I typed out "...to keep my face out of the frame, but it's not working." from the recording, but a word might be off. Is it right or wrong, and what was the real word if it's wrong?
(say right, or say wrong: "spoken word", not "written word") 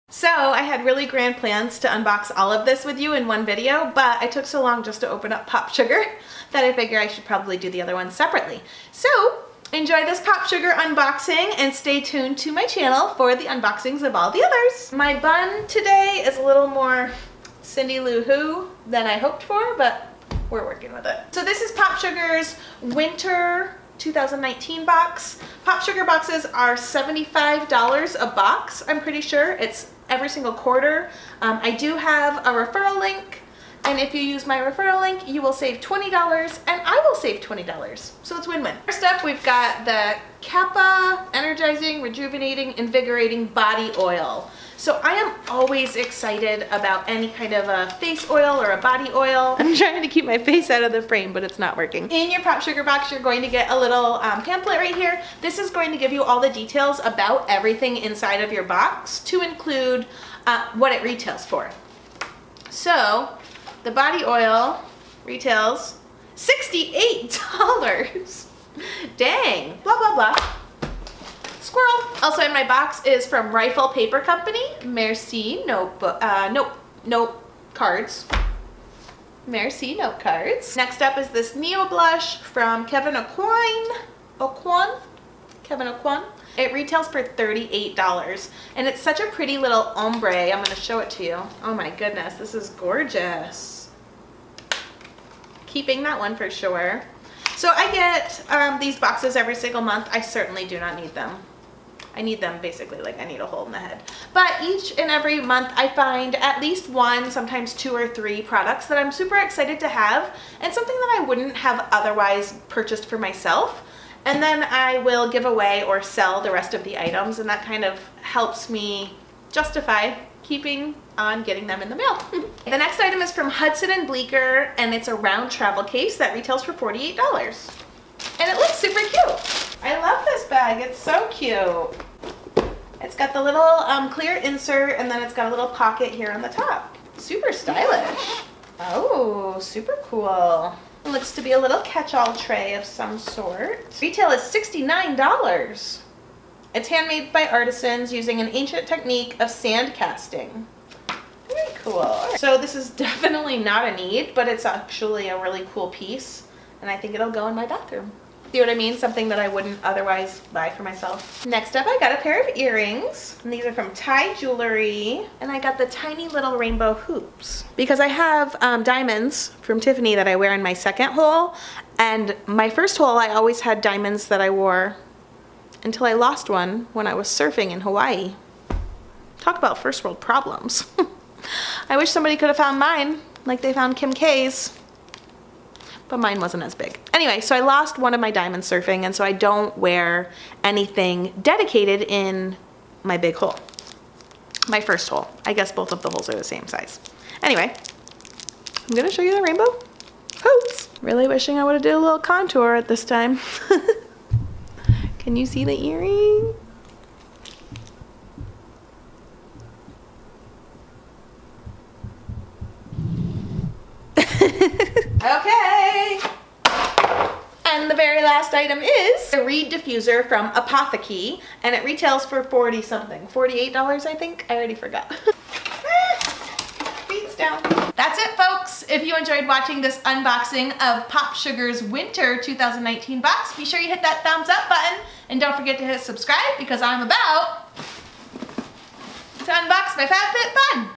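right.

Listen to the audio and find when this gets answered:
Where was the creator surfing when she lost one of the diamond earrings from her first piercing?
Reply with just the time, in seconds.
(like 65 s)
177 s.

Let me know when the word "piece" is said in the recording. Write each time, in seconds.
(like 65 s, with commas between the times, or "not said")
155 s.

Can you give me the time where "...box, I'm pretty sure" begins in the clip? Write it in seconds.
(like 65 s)
28 s.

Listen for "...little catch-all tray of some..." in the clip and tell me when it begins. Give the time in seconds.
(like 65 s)
141 s.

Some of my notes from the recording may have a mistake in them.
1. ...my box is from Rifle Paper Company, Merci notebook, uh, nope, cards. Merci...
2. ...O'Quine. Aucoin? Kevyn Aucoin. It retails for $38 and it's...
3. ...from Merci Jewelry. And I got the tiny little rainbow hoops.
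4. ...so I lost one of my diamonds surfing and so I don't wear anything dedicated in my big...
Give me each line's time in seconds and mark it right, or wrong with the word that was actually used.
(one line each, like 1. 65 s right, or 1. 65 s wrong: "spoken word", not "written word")
1. 72 s right
2. 83 s right
3. 163 s wrong: "Tai", not "Merci"
4. 187 s right.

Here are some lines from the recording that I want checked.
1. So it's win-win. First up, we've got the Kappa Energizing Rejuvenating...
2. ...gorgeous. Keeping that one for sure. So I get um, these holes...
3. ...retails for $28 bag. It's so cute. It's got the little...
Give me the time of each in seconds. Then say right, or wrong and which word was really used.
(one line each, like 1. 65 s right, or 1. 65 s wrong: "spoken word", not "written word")
1. 38 s right
2. 92 s wrong: "boxes", not "holes"
3. 126 s wrong: "48", not "28".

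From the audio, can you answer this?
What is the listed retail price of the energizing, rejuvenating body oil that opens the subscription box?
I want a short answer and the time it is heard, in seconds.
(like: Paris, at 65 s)
$68, at 66 s.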